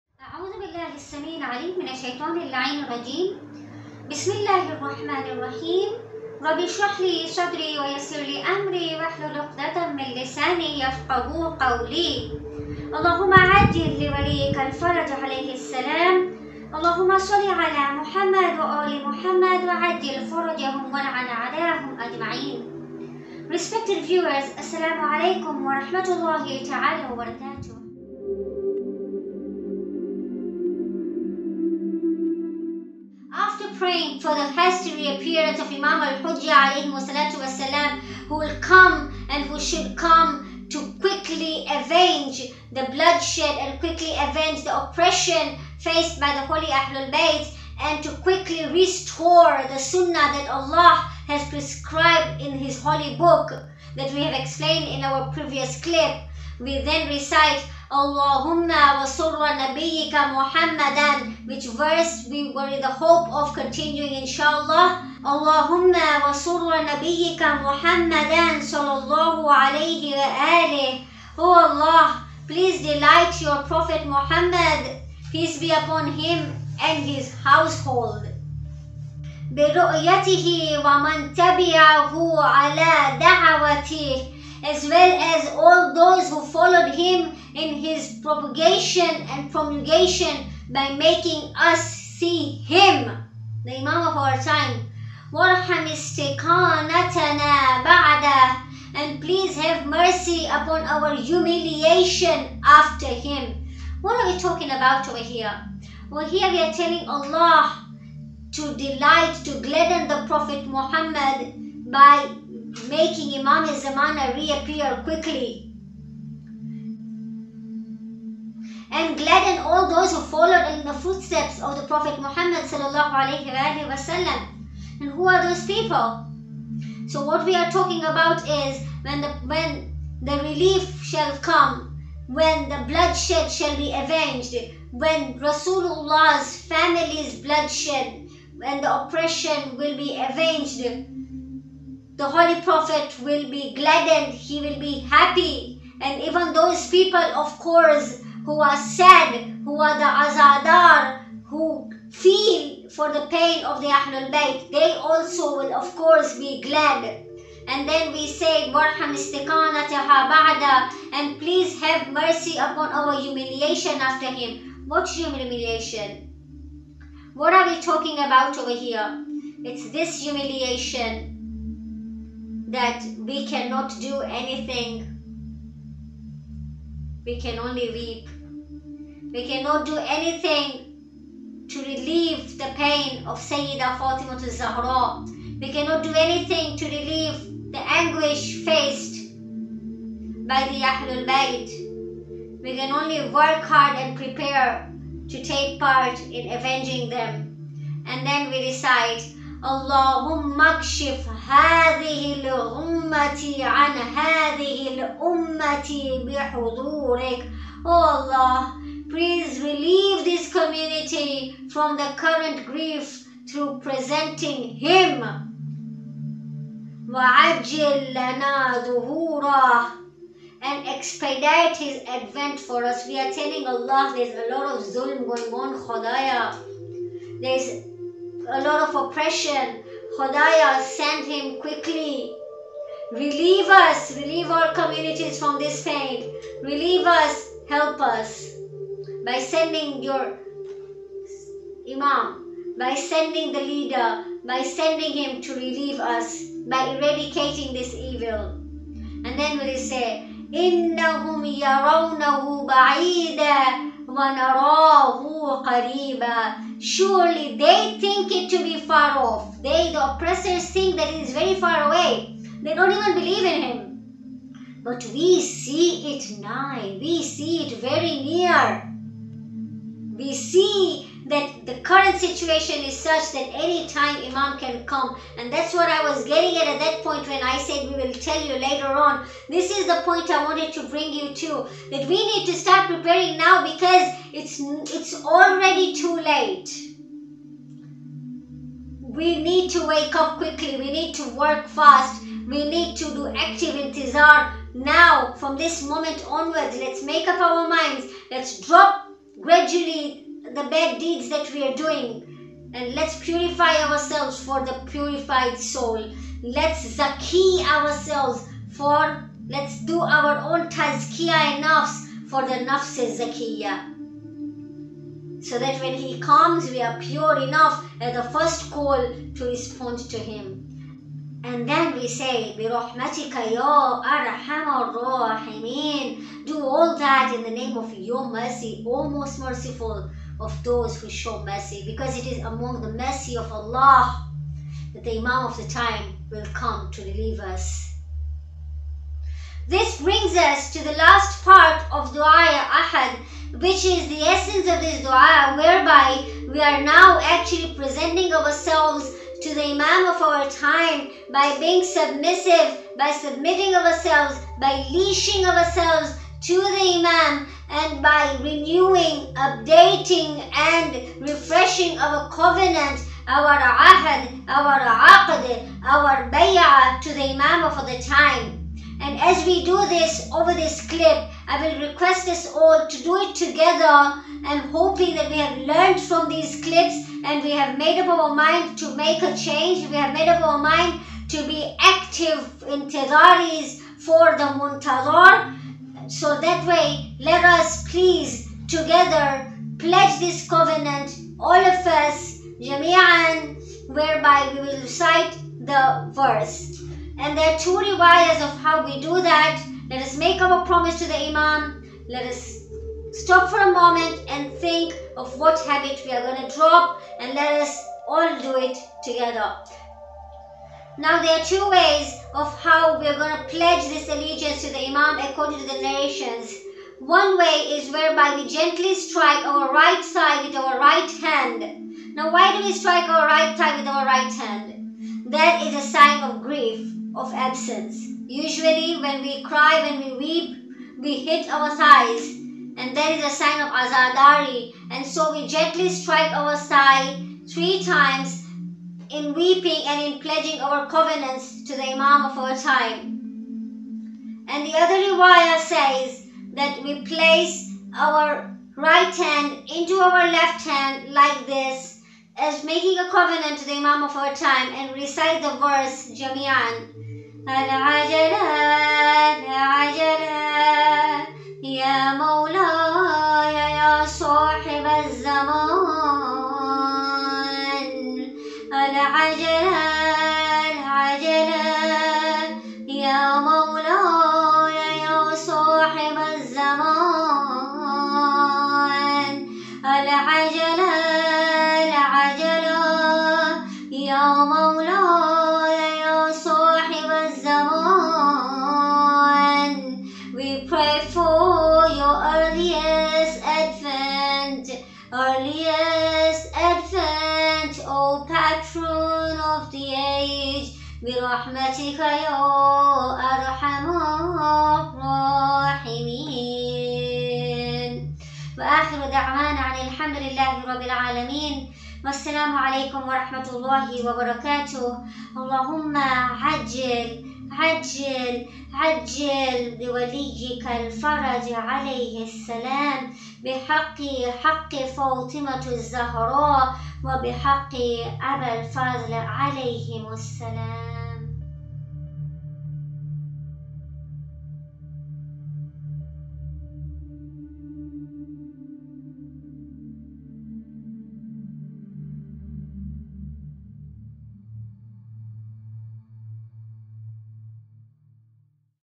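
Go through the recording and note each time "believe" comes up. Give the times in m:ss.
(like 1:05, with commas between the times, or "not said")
4:23.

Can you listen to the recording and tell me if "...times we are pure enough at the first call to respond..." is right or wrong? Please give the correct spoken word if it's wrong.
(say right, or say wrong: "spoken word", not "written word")
wrong: "comes", not "times".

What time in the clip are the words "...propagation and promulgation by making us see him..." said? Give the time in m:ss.
1:28.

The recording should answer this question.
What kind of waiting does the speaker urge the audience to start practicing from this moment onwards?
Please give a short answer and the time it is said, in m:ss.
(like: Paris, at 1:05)
Active intizar, at 4:53.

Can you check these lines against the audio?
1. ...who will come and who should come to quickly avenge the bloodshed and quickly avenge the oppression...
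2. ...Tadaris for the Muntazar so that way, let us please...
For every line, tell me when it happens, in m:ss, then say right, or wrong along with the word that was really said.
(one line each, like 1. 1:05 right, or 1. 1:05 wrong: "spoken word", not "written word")
1. 0:38 right
2. 6:22 right.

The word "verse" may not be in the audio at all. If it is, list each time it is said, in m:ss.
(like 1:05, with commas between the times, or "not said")
1:01, 6:36, 7:35.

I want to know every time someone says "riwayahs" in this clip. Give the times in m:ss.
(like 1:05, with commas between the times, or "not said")
6:37, 7:24.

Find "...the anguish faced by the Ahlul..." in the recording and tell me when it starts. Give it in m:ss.
3:07.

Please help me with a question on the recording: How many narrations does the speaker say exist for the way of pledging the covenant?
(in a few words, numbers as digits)
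2.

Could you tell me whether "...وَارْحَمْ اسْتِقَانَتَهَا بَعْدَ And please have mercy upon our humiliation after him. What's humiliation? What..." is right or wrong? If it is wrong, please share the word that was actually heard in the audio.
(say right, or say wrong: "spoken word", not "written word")
right.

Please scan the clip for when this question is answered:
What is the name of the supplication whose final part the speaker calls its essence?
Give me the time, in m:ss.
5:42.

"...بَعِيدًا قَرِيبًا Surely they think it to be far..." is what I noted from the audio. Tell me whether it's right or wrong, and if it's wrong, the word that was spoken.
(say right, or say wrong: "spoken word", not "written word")
right.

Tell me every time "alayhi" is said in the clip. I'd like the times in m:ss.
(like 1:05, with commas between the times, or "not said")
0:36, 1:09.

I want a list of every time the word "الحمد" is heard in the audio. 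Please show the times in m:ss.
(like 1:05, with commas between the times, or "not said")
8:29.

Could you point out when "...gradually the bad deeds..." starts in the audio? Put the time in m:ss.
4:59.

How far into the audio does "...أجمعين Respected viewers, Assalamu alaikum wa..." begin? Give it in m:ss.
0:21.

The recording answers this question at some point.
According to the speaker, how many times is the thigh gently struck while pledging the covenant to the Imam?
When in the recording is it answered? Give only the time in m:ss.
7:17.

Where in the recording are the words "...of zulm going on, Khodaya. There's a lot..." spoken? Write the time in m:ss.
3:44.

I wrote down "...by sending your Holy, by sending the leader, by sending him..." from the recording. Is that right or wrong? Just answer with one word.
wrong.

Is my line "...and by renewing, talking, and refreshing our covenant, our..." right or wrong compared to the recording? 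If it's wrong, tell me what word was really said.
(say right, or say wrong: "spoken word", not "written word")
wrong: "updating", not "talking".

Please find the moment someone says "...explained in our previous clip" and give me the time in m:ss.
0:54.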